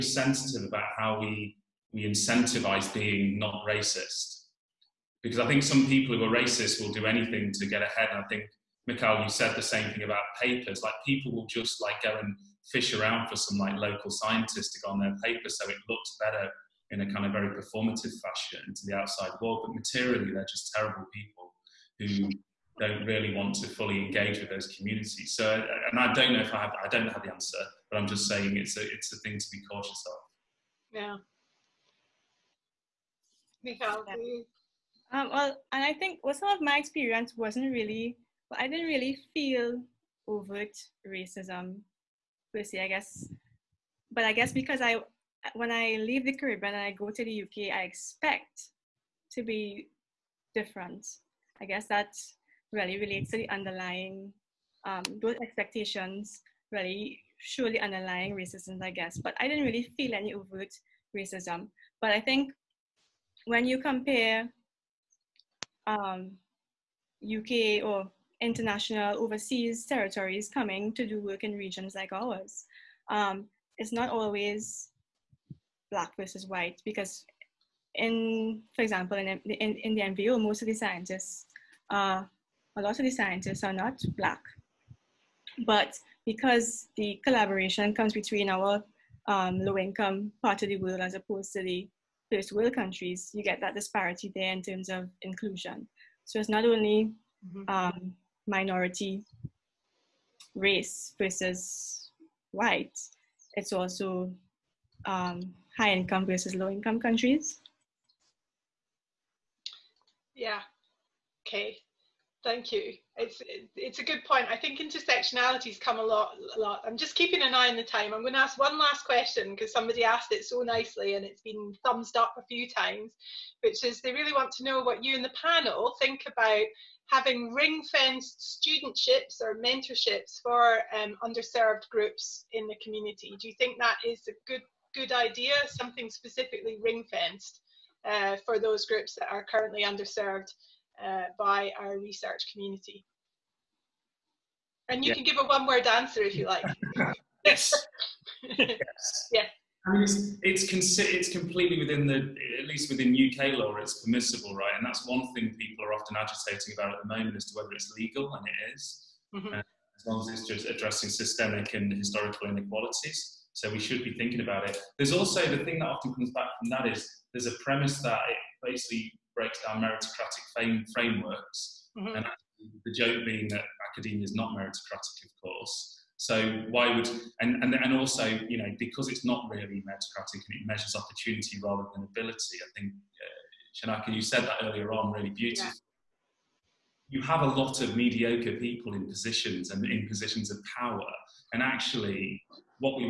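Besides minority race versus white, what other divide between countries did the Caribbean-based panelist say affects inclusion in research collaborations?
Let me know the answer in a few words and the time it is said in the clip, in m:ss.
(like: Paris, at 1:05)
high income versus low income, at 1:45.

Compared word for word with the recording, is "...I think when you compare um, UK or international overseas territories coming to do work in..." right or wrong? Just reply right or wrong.
right.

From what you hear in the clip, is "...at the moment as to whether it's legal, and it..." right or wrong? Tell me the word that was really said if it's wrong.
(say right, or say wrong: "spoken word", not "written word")
right.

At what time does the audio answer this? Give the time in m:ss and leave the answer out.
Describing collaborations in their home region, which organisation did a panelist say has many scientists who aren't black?
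1:20.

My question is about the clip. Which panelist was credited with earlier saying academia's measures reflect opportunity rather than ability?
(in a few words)
Shanaka.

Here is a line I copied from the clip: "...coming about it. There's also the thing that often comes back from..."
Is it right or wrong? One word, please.
wrong.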